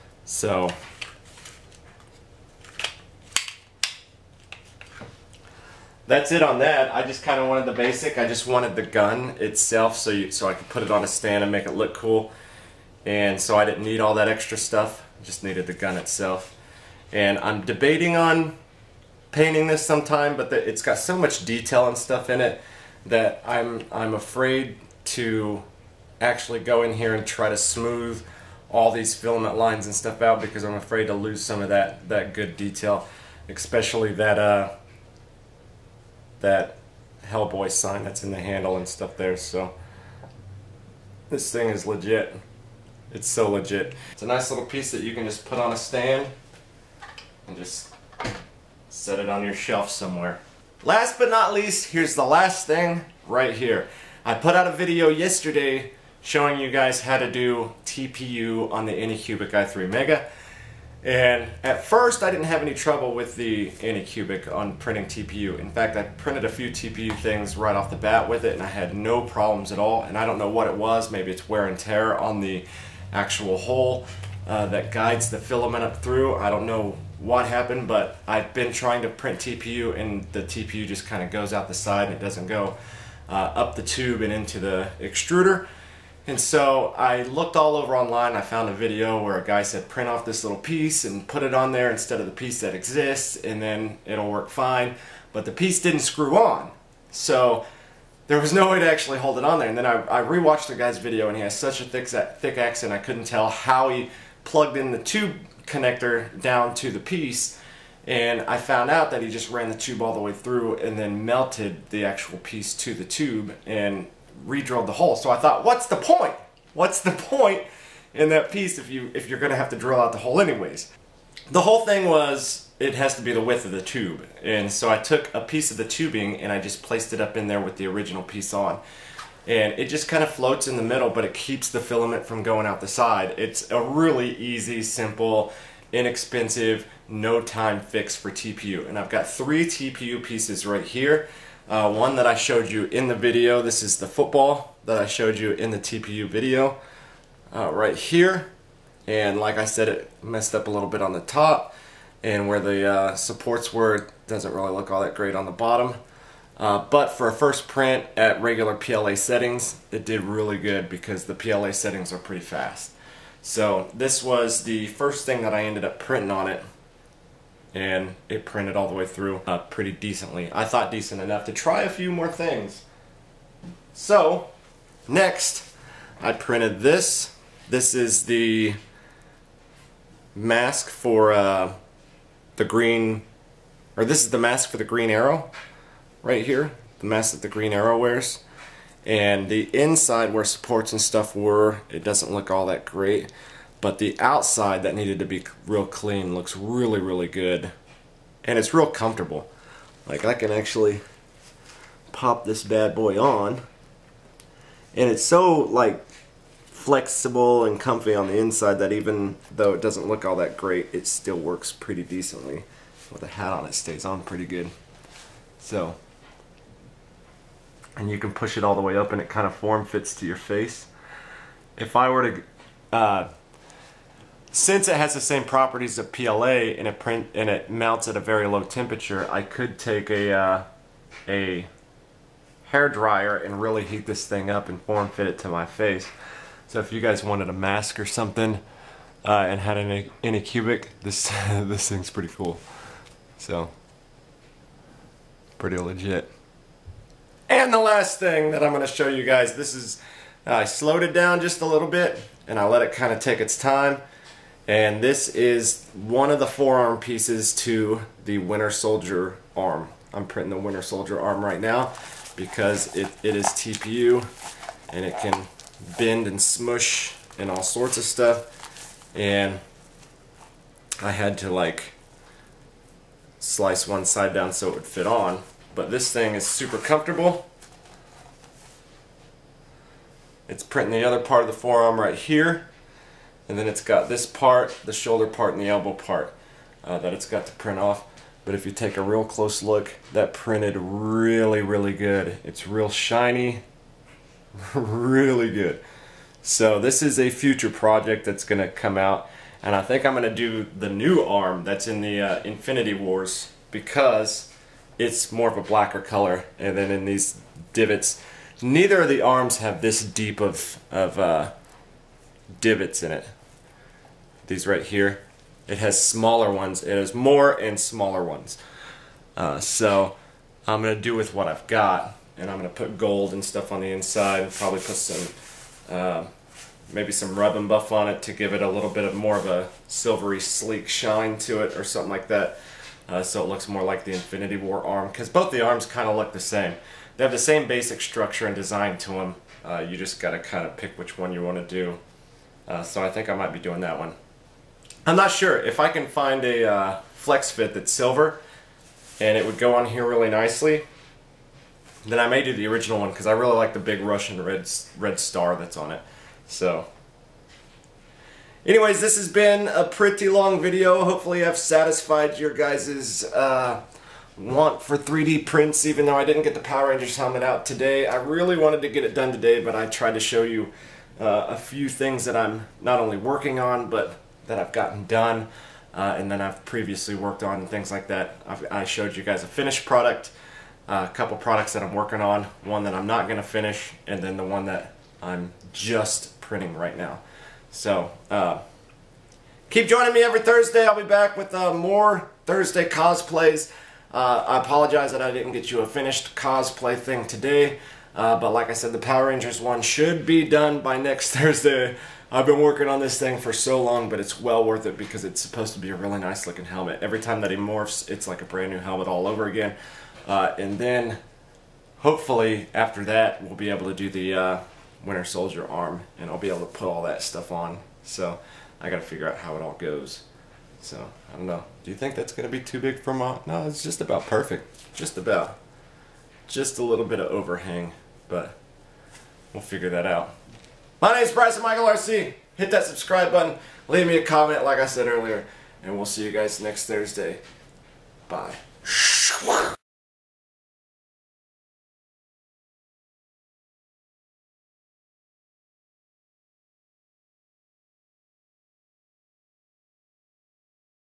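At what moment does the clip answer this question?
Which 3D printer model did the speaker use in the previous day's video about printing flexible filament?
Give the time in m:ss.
0:58.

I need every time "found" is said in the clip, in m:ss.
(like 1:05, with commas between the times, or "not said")
1:28, 1:48.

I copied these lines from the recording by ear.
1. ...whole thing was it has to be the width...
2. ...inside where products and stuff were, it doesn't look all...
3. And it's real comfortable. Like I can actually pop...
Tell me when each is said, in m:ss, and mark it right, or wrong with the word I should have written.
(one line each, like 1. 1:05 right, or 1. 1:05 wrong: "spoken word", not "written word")
1. 2:01 right
2. 3:09 wrong: "supports", not "products"
3. 3:18 right.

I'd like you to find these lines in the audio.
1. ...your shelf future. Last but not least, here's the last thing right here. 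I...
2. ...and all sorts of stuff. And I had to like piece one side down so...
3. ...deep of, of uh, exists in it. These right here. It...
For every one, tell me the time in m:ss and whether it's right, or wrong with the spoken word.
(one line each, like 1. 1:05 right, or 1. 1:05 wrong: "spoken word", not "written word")
1. 0:49 wrong: "somewhere", not "future"
2. 4:27 wrong: "slice", not "piece"
3. 5:10 wrong: "divots", not "exists".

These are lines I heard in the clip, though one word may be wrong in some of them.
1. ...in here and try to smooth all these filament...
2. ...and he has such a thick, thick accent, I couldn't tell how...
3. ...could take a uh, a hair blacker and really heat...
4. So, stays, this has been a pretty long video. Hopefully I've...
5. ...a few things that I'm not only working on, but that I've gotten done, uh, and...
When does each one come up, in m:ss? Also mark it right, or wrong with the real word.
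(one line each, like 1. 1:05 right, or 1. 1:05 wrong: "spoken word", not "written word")
1. 0:26 right
2. 1:41 right
3. 3:49 wrong: "dryer", not "blacker"
4. 5:56 wrong: "anyways", not "stays"
5. 6:11 right.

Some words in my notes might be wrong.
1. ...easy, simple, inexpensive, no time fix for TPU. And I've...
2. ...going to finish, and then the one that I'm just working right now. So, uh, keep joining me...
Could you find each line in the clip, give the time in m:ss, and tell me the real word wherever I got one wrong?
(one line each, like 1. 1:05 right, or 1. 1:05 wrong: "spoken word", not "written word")
1. 2:14 right
2. 6:23 wrong: "printing", not "working".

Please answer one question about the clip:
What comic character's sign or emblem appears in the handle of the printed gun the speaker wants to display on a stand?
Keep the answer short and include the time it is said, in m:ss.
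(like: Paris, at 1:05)
Hellboy, at 0:37.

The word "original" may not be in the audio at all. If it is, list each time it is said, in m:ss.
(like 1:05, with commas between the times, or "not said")
2:07, 5:52.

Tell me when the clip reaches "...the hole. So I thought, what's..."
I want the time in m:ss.
1:54.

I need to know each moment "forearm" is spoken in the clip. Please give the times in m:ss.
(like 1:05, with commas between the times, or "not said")
4:16, 4:41.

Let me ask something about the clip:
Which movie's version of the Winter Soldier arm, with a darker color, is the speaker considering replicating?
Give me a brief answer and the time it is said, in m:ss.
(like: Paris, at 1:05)
Infinity War, at 5:02.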